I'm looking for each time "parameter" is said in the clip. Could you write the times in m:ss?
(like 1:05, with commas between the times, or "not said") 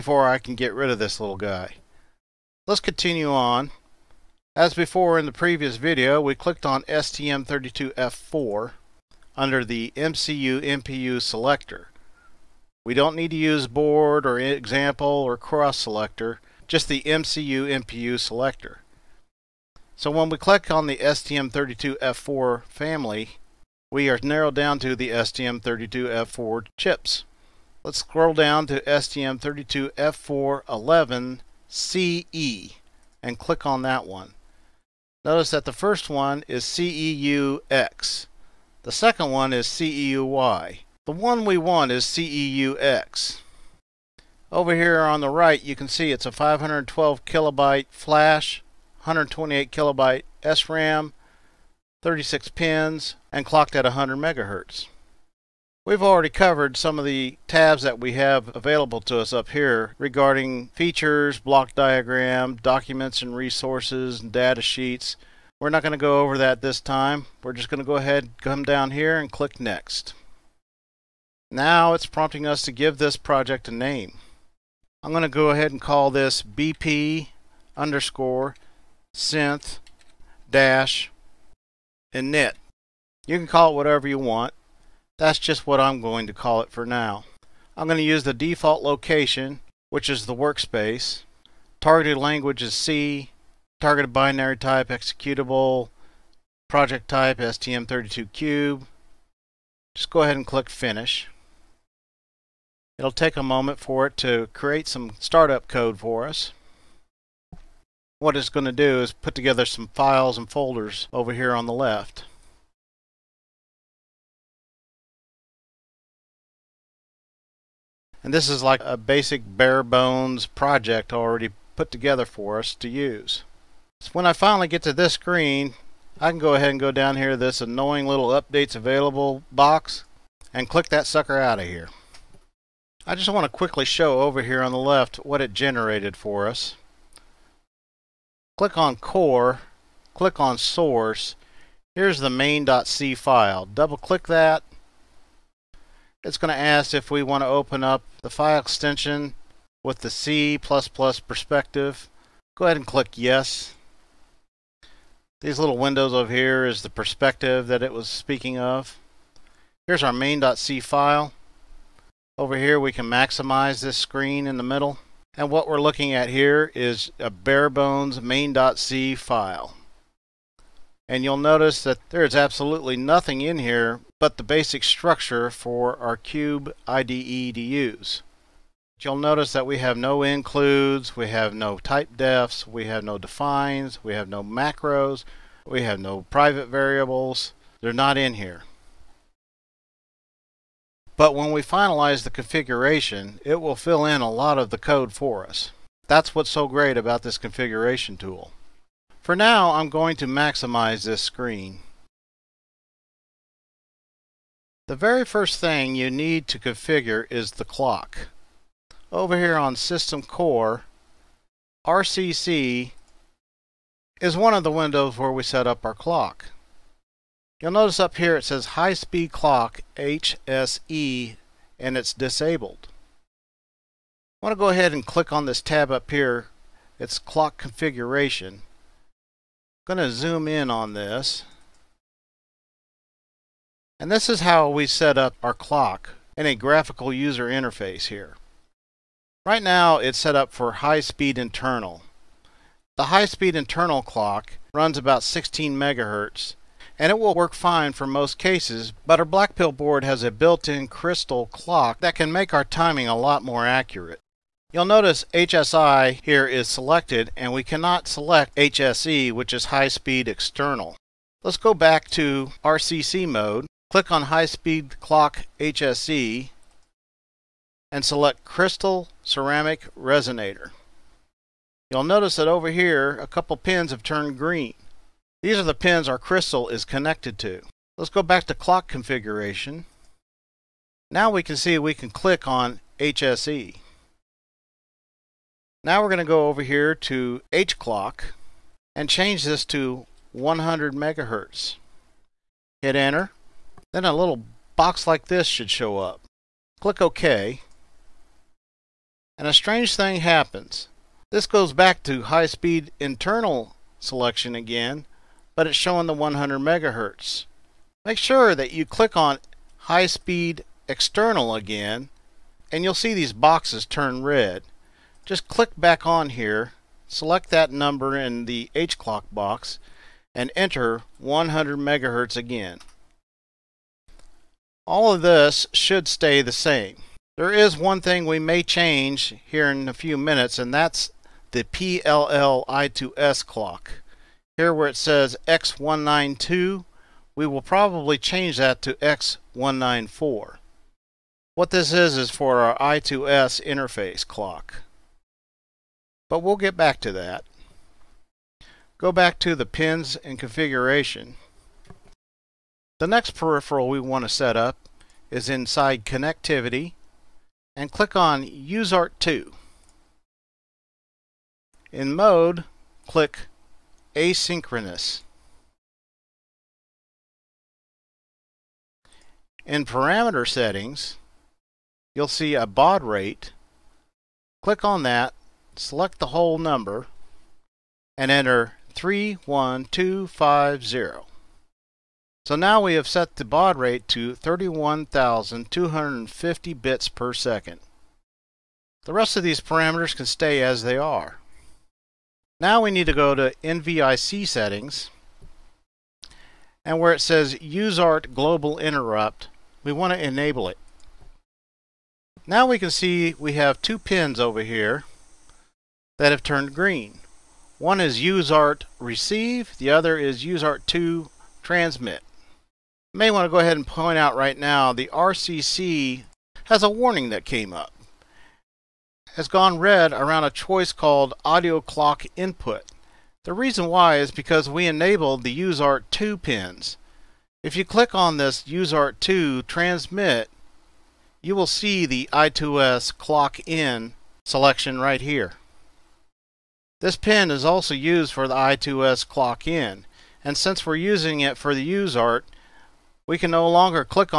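6:09, 6:29.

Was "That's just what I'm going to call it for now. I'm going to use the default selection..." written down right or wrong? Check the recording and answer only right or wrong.
wrong.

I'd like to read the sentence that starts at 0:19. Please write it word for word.
So when we click on the STM32F4 family, we are narrowed down to the STM32F4 chips.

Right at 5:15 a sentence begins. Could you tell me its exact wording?
Just click back on here, select that number in the H clock box, and enter 100 megahertz again.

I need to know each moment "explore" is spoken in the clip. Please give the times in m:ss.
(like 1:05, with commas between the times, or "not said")
not said.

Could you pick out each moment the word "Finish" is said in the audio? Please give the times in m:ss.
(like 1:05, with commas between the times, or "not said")
1:40.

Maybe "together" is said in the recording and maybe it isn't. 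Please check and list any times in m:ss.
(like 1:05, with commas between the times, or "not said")
1:49, 2:01.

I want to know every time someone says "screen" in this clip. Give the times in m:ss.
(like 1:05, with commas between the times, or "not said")
2:05, 2:43, 3:21.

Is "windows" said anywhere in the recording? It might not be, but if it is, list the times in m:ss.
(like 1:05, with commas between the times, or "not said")
2:35, 3:34.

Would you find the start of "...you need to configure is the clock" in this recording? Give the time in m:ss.
3:25.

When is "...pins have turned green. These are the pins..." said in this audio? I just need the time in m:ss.
4:33.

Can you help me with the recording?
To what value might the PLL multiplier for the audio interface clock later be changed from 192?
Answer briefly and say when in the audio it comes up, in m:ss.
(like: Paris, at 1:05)
194, at 5:38.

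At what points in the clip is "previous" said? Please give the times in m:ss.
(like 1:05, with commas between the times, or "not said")
0:05.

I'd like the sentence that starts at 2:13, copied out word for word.
I just want to quickly show over here on the left what it generated for us.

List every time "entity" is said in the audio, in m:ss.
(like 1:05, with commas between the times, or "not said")
not said.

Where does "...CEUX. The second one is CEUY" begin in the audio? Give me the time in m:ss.
0:36.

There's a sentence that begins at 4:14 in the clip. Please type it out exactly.
You'll notice HSI here is selected and we cannot select HSE which is high-speed external.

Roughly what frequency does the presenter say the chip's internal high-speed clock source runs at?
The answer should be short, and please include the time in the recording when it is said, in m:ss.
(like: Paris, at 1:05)
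16 megahertz, at 4:05.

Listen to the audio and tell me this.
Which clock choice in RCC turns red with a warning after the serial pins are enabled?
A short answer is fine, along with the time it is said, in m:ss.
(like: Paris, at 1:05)
audio clock input, at 7:01.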